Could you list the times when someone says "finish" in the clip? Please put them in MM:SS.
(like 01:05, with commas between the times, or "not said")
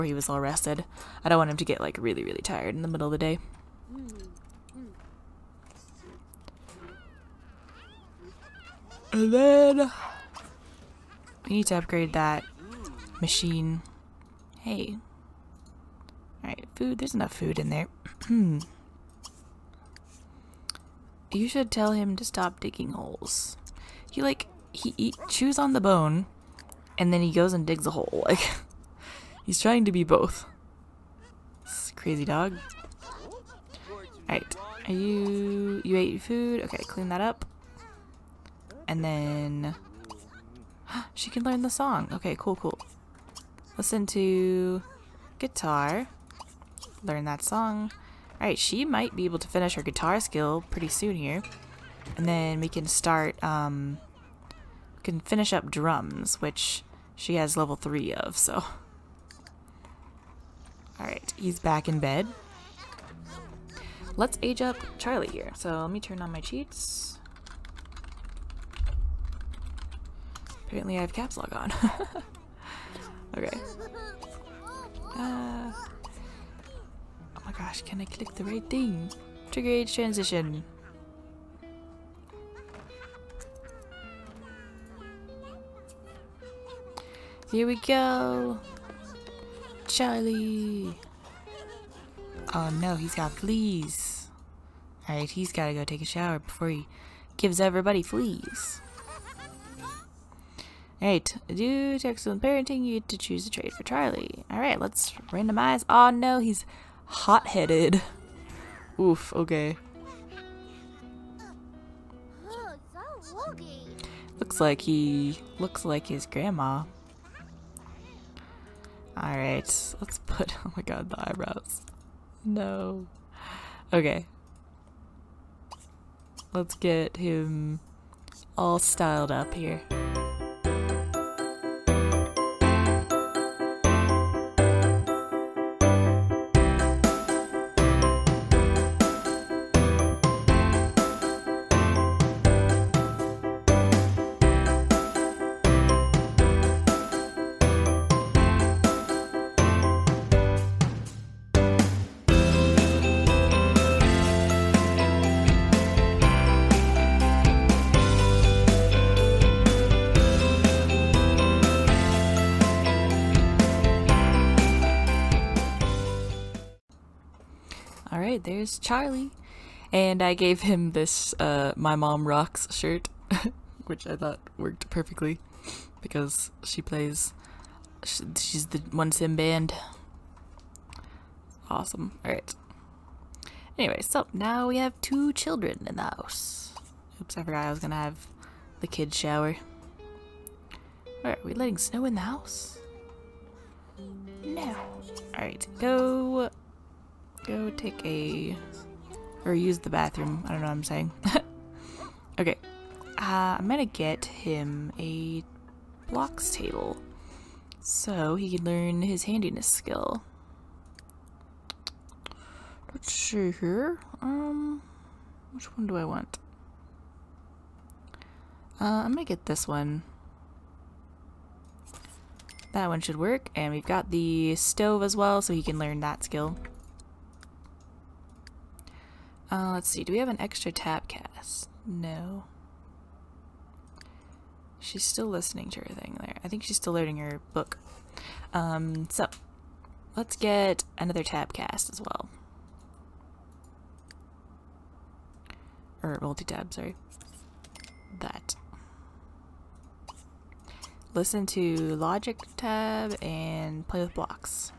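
00:49, 00:55.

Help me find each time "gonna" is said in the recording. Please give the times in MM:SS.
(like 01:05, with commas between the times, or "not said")
03:07, 03:23, 03:39.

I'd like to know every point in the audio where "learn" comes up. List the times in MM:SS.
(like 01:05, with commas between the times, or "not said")
00:41, 00:47, 03:28, 03:45.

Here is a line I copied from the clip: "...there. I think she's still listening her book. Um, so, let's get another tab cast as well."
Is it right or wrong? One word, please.
wrong.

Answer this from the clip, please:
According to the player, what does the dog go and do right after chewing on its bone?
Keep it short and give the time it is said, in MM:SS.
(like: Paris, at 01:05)
Digs a hole, at 00:27.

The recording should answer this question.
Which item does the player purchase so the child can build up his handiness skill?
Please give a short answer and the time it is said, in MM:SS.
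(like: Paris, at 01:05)
Blocks table, at 03:26.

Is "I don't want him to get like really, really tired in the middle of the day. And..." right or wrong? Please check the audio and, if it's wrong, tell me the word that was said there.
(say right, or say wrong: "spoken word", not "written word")
right.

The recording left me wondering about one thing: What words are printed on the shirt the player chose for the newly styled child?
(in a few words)
My Mom Rocks.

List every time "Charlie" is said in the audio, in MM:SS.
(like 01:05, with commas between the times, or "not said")
01:04, 01:29, 01:43, 02:48.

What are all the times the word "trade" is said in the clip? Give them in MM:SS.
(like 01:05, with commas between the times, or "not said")
01:43.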